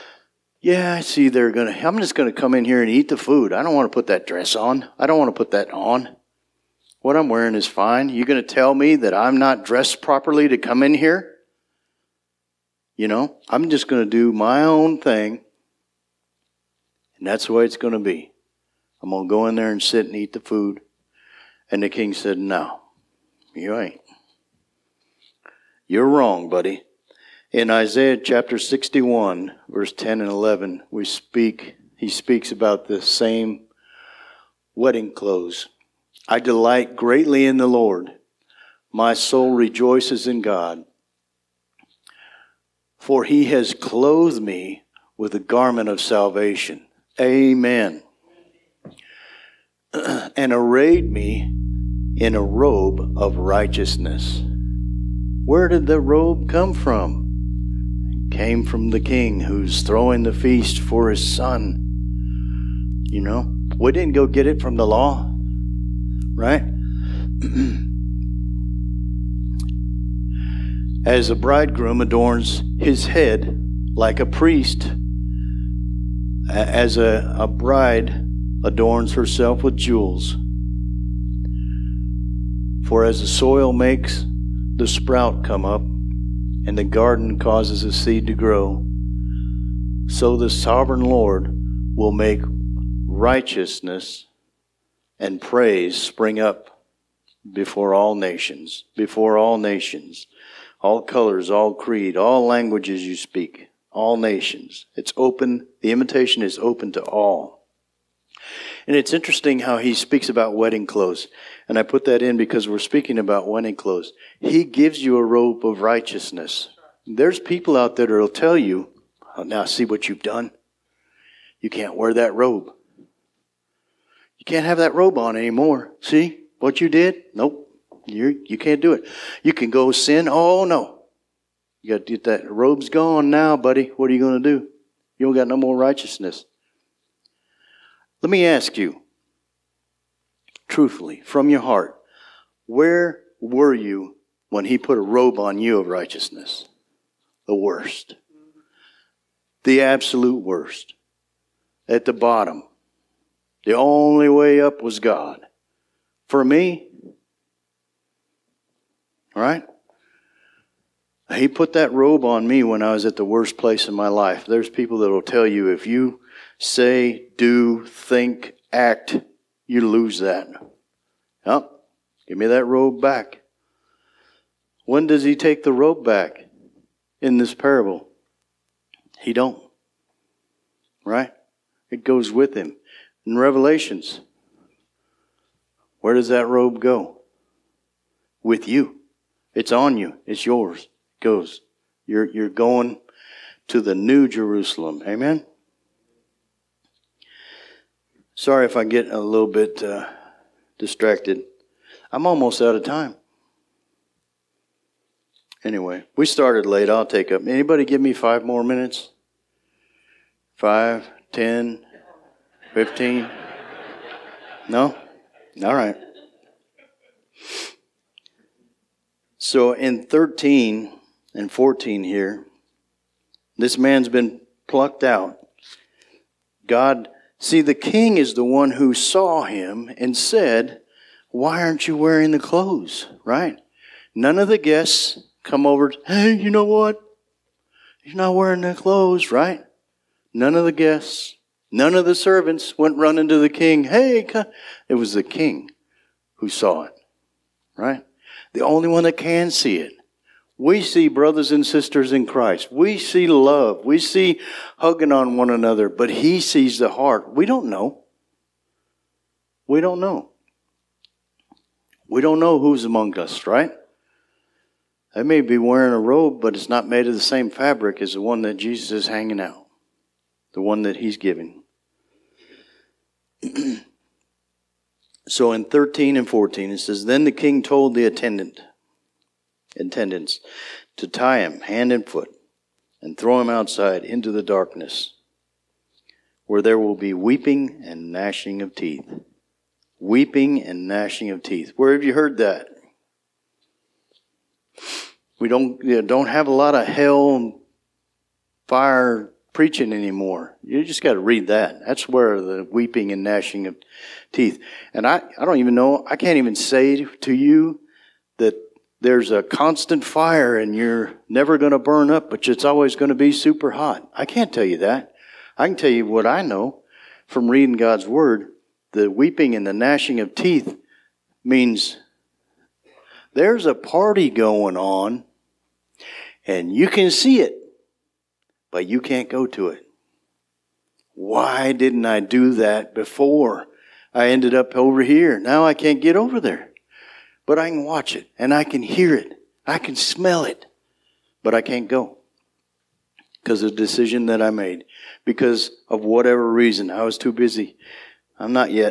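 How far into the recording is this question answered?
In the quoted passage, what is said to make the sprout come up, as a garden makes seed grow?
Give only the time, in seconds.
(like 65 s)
83 s.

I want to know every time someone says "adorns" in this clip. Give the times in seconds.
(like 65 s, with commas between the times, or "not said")
72 s, 78 s.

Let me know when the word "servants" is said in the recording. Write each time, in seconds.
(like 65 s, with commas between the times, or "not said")
242 s.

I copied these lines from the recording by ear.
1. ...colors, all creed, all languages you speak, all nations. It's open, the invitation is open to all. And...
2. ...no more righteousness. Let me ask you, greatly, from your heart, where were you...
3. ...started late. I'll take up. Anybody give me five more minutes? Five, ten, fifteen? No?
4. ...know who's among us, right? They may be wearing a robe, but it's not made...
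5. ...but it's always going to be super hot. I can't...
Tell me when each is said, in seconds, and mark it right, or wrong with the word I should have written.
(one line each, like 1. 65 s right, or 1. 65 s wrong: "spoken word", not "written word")
1. 101 s right
2. 135 s wrong: "truthfully", not "greatly"
3. 206 s right
4. 262 s right
5. 312 s right.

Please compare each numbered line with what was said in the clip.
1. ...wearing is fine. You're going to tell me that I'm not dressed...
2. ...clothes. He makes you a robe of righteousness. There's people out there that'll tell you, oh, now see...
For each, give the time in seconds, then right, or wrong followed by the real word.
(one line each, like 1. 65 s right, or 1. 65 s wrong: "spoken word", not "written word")
1. 7 s right
2. 113 s wrong: "gives", not "makes".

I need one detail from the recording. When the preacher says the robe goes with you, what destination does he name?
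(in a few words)
New Jerusalem.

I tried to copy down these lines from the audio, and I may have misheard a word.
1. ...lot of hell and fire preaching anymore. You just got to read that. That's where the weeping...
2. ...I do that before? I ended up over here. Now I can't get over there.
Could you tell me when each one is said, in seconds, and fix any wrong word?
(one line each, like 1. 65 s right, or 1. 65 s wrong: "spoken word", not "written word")
1. 296 s right
2. 332 s right.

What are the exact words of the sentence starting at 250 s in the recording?
We see brothers and sisters in Christ.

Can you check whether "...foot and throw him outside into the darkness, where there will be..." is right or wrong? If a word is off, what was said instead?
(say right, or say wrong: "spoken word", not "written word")
right.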